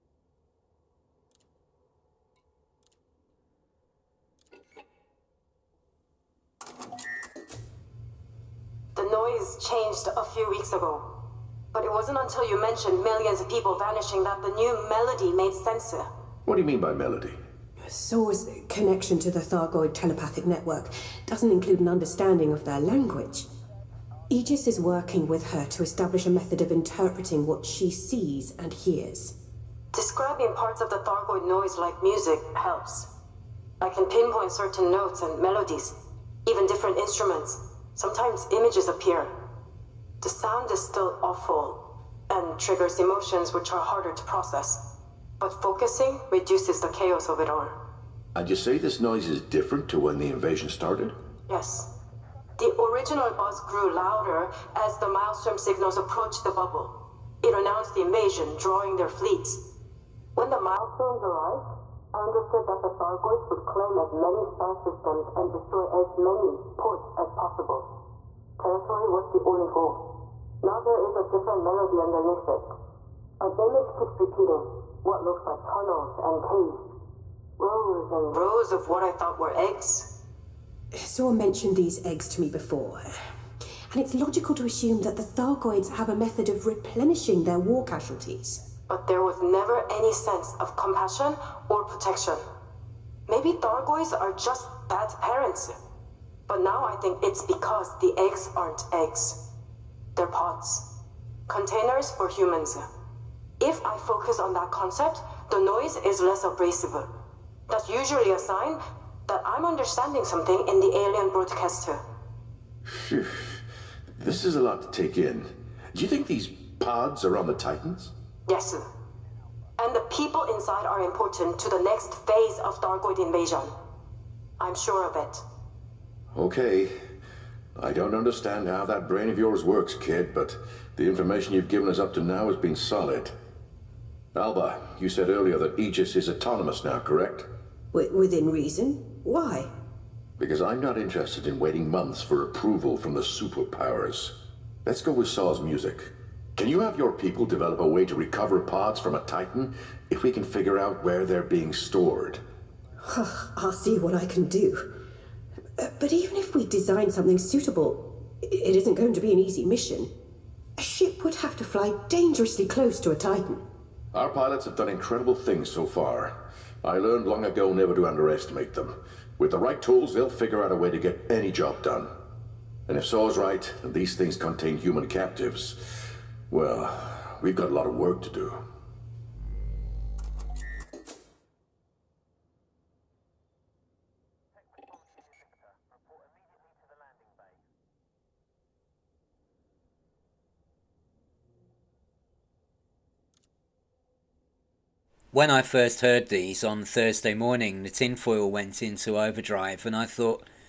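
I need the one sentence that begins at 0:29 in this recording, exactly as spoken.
Describing parts of the Thargoid noise like music helps.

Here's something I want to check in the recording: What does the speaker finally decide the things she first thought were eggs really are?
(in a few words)
containers for humans.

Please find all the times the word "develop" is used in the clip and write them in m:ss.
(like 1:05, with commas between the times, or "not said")
2:27.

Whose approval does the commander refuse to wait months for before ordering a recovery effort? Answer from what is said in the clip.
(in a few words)
the superpowers.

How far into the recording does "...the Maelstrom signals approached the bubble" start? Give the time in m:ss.
0:54.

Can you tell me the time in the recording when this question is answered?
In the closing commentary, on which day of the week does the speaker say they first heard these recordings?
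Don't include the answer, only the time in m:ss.
3:16.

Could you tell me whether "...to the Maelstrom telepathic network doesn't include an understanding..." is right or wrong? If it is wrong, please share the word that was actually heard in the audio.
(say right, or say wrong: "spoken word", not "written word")
wrong: "Thargoid", not "Maelstrom".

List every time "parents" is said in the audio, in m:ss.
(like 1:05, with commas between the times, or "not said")
1:35.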